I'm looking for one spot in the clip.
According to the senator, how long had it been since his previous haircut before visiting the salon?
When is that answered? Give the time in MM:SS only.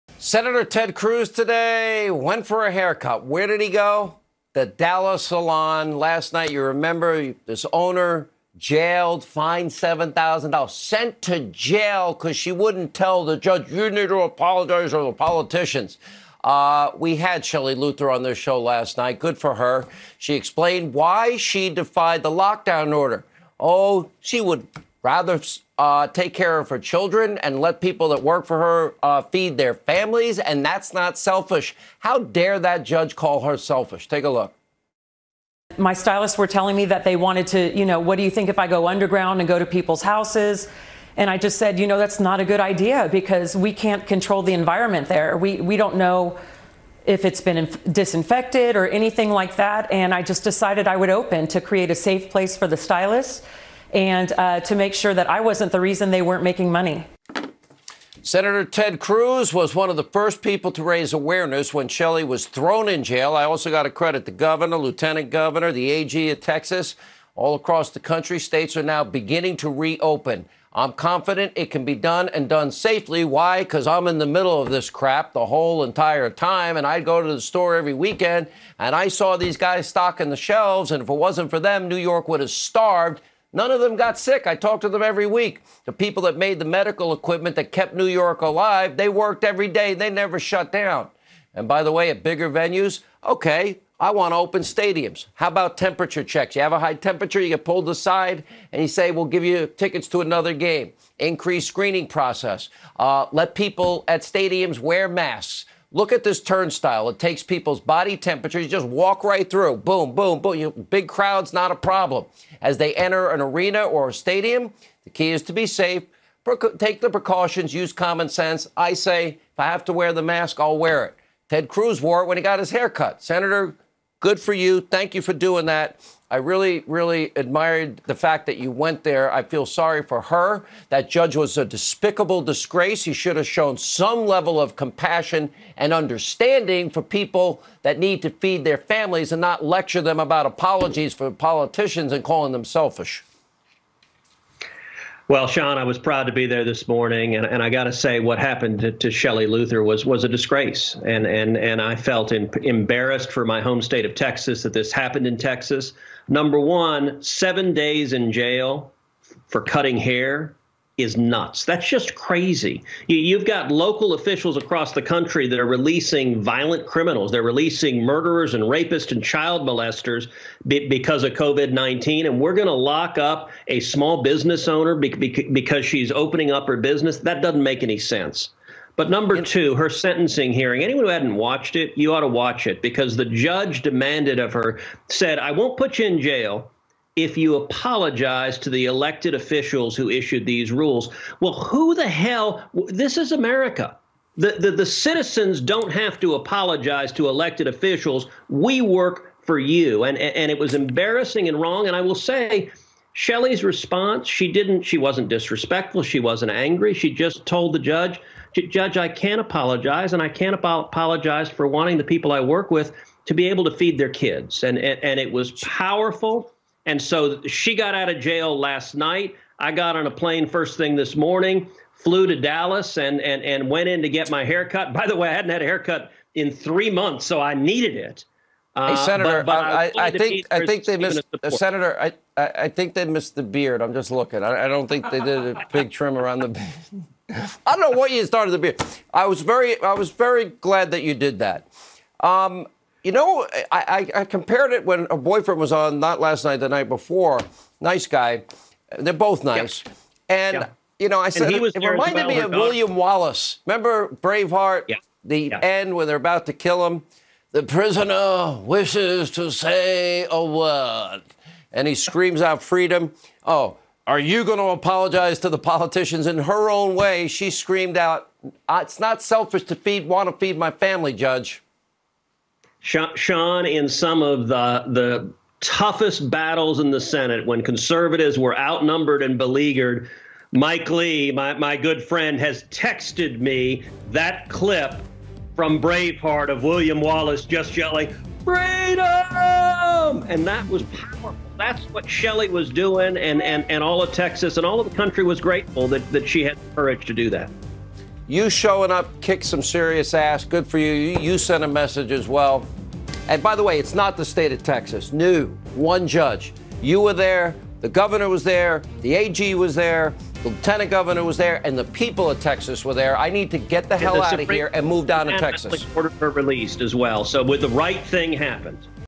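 03:46.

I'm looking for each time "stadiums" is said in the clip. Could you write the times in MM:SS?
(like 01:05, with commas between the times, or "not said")
01:34, 01:44, 01:54.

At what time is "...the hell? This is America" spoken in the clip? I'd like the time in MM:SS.
03:11.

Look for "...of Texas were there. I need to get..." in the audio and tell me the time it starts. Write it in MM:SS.
05:12.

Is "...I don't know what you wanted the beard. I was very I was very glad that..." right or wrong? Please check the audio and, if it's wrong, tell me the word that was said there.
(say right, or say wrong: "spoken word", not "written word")
wrong: "started", not "wanted".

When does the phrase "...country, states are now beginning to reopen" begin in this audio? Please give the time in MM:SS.
01:07.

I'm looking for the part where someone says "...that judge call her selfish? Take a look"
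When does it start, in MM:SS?
00:32.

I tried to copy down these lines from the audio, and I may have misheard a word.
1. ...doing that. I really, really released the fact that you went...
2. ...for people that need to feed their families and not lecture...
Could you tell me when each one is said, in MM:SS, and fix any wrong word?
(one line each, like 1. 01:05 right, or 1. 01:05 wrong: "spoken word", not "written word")
1. 02:05 wrong: "admired", not "released"
2. 02:16 right.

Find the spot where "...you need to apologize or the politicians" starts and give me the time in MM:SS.
00:13.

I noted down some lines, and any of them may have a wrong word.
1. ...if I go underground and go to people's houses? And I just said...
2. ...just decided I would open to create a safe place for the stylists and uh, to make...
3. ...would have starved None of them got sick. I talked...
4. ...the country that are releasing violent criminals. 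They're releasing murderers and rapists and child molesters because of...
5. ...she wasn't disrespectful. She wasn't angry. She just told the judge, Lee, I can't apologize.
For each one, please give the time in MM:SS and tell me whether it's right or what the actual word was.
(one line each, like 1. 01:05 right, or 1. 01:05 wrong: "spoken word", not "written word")
1. 00:38 right
2. 00:50 right
3. 01:22 right
4. 02:44 right
5. 03:24 wrong: "Judge", not "Lee".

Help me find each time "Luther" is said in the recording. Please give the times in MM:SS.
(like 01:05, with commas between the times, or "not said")
00:17, 02:29.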